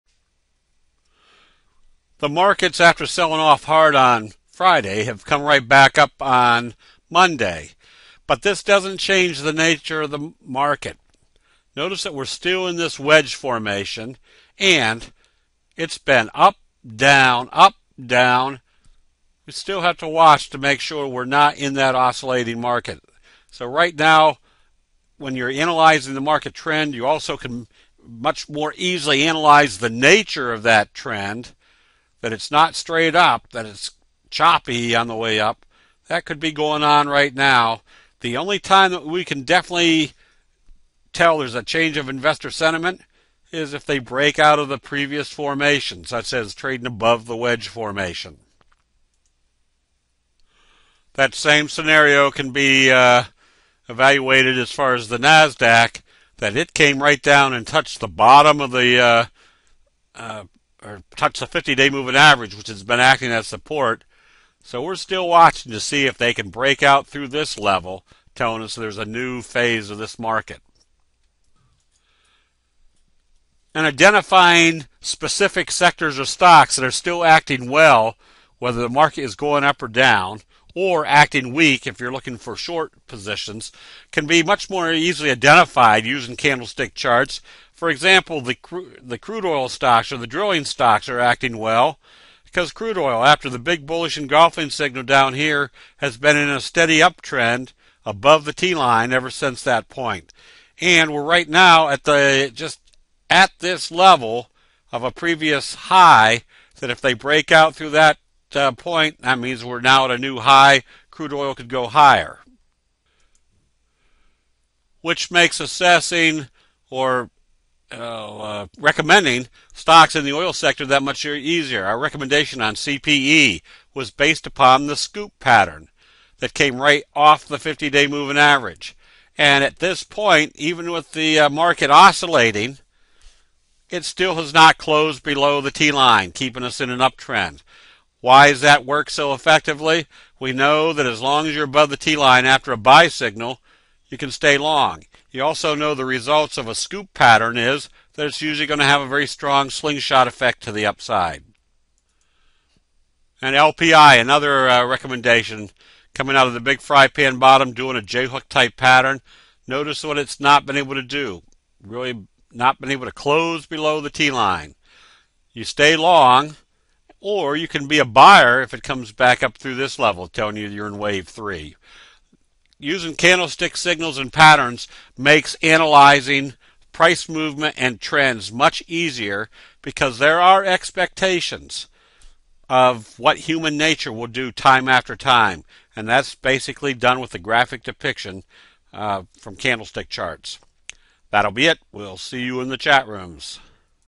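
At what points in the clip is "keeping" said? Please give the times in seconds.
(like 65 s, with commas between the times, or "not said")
136 s.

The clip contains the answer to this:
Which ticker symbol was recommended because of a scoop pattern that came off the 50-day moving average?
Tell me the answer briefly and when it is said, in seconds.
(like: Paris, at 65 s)
CPE, at 122 s.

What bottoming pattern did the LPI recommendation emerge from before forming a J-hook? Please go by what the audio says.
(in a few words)
fry pan bottom.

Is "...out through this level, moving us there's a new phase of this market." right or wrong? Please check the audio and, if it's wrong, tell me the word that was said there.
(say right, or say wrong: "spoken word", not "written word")
wrong: "telling", not "moving".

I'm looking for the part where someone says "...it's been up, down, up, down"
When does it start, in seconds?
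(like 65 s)
15 s.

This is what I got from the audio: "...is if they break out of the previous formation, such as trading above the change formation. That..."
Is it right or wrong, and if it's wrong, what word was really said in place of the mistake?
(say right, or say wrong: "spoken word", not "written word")
wrong: "wedge", not "change".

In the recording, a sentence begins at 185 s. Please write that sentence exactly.
And that's basically done with the graphic depiction uh, from candlestick charts.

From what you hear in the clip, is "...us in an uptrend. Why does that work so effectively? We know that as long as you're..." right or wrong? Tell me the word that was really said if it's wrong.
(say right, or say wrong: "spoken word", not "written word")
right.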